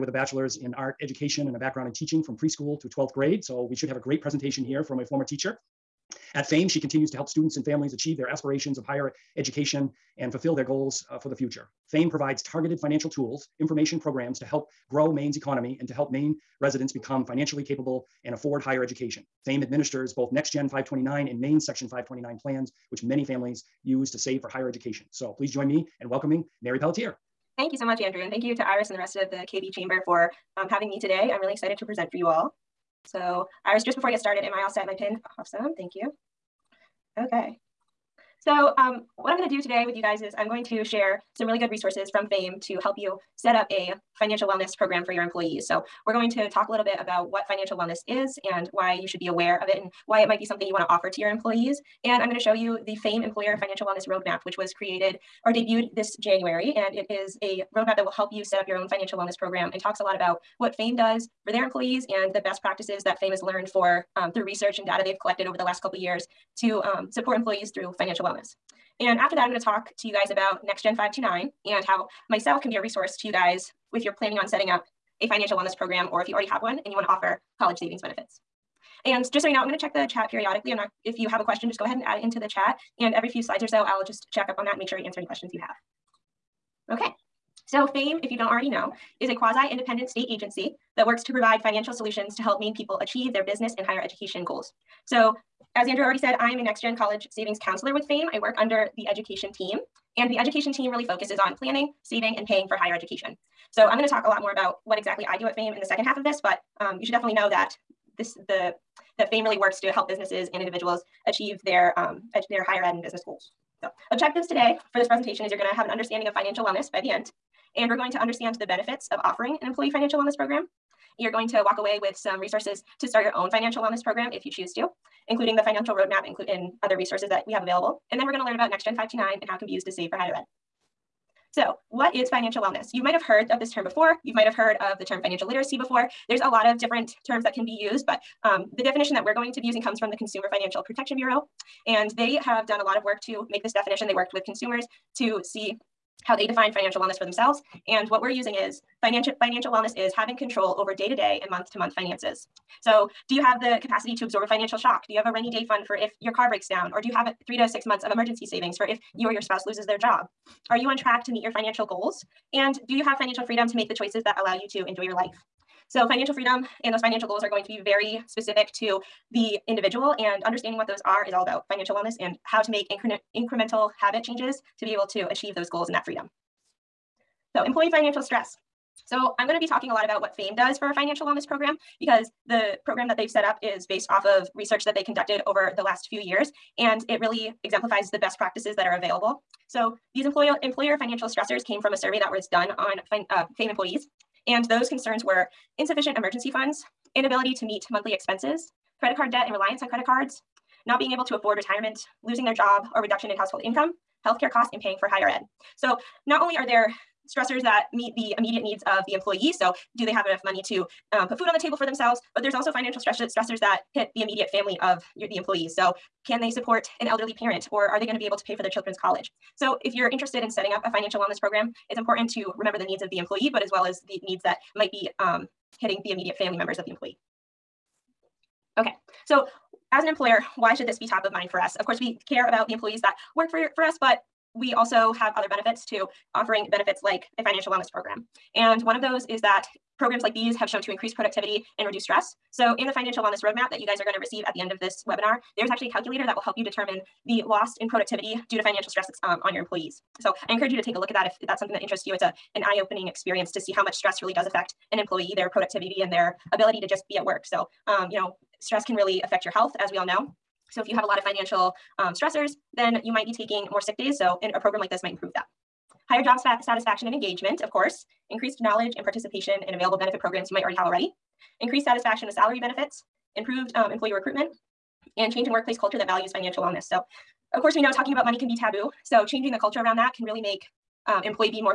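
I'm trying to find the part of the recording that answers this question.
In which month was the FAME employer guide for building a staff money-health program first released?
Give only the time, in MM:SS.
00:56.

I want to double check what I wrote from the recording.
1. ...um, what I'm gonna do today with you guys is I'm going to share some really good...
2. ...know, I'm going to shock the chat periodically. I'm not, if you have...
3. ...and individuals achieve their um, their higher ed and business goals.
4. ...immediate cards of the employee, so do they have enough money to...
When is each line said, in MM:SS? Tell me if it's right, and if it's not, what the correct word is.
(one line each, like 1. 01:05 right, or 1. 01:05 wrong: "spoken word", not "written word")
1. 00:38 right
2. 01:19 wrong: "check", not "shock"
3. 01:50 right
4. 03:28 wrong: "needs", not "cards".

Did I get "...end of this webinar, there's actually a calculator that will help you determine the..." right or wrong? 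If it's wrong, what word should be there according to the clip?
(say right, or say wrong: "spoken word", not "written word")
right.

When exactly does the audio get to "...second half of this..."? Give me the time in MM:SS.
01:45.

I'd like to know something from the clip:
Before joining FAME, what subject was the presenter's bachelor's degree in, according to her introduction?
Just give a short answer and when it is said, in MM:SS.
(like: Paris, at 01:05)
Art education, at 00:00.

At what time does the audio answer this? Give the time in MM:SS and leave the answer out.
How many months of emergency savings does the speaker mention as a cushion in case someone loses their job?
02:37.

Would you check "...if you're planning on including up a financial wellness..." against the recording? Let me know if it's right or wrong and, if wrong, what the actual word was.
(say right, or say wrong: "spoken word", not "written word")
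wrong: "setting", not "including".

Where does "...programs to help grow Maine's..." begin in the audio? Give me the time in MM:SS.
00:13.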